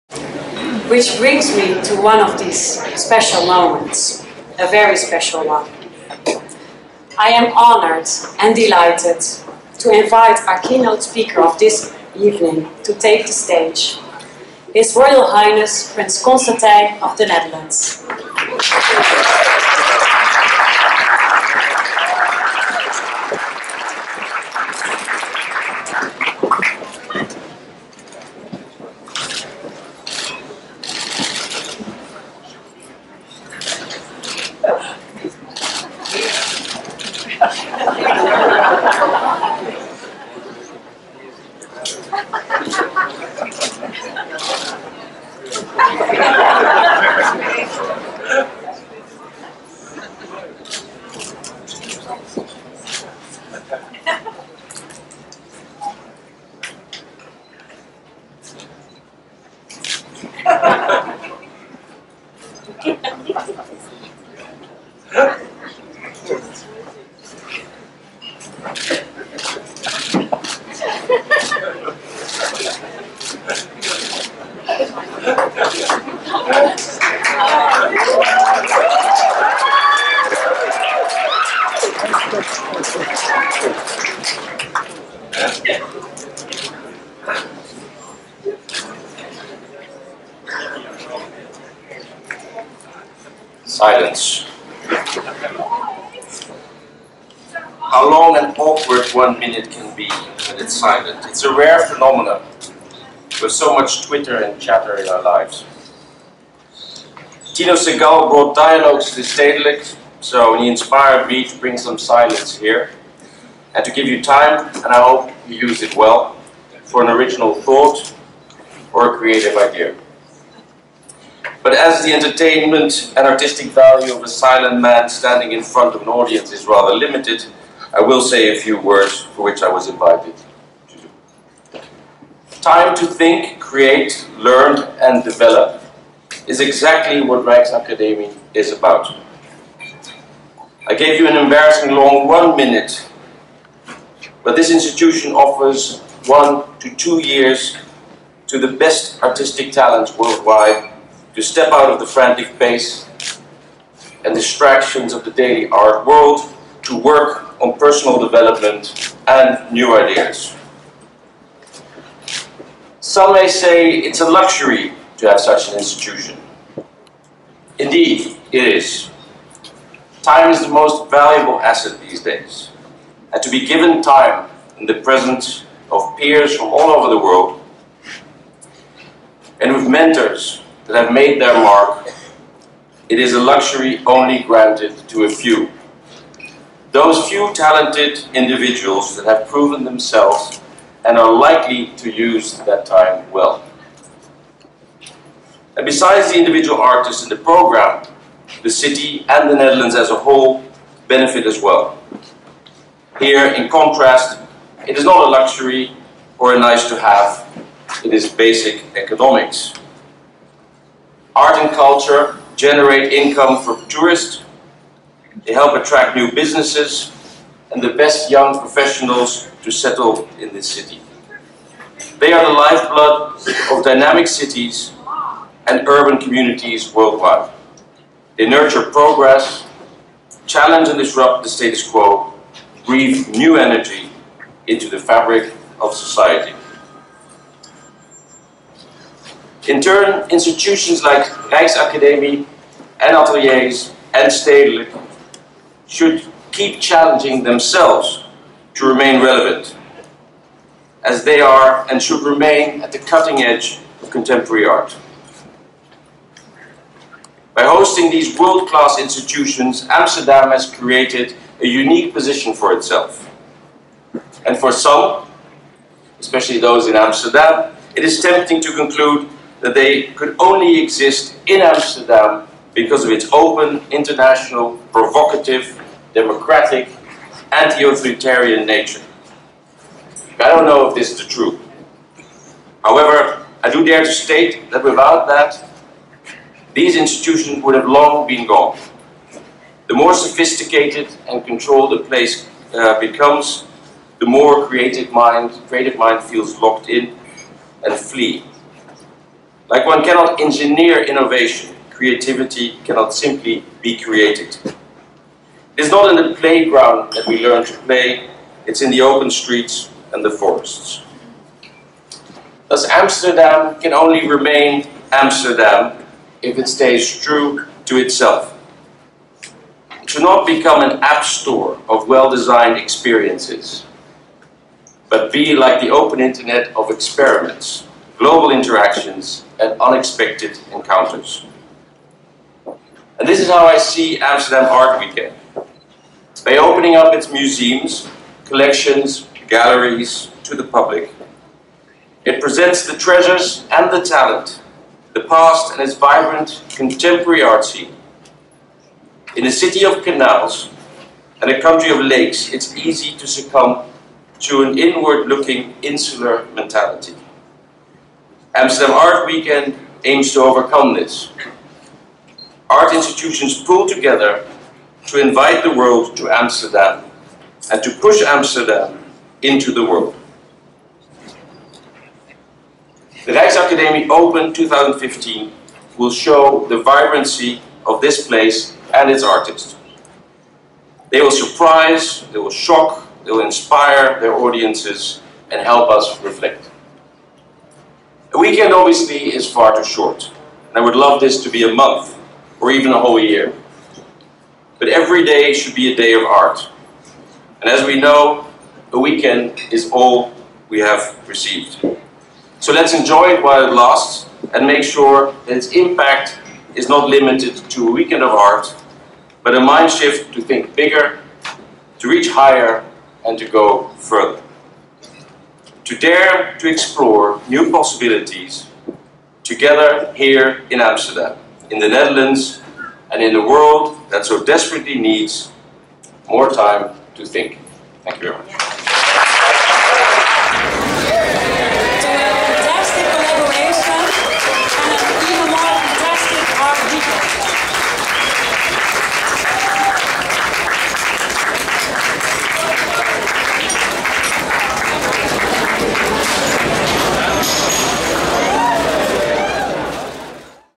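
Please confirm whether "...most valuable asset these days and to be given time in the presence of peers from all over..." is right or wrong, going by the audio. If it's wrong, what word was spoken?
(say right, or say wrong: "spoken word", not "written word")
right.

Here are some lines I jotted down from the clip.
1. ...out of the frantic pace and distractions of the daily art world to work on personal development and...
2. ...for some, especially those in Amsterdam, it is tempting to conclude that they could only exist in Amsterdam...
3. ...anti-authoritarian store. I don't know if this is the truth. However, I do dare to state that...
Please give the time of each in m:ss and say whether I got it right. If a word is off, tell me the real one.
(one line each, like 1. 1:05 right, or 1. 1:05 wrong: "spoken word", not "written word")
1. 2:31 right
2. 4:24 right
3. 4:37 wrong: "nature", not "store".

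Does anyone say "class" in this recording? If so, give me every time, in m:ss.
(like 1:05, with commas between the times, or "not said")
4:18.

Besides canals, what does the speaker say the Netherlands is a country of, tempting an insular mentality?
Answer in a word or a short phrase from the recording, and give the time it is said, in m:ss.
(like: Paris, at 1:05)
Lakes, at 5:52.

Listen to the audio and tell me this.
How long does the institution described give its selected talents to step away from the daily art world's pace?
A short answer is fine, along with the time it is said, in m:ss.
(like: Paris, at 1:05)
1 to 2 years, at 2:26.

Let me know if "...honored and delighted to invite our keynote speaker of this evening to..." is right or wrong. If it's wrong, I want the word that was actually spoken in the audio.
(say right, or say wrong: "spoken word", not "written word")
right.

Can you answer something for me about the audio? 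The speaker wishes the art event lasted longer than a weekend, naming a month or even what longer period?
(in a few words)
A whole year.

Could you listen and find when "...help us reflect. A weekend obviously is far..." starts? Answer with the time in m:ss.
6:25.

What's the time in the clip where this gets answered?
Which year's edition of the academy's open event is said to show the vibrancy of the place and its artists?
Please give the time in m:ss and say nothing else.
6:14.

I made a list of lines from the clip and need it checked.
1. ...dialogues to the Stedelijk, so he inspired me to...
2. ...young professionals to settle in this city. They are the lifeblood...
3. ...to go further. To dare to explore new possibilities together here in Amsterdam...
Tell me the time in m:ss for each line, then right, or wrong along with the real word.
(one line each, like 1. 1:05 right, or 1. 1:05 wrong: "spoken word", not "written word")
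1. 1:48 right
2. 3:38 right
3. 6:53 right.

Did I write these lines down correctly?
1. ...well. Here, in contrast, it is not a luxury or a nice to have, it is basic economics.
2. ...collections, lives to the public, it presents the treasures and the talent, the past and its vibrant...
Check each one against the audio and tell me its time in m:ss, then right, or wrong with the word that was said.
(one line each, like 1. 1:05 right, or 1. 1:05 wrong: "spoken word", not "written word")
1. 3:21 right
2. 5:38 wrong: "galleries", not "lives".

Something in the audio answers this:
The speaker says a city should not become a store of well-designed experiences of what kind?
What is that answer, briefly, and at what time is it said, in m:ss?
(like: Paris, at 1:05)
An app store, at 5:20.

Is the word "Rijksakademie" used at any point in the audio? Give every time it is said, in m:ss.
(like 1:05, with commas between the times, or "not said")
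4:01, 6:13.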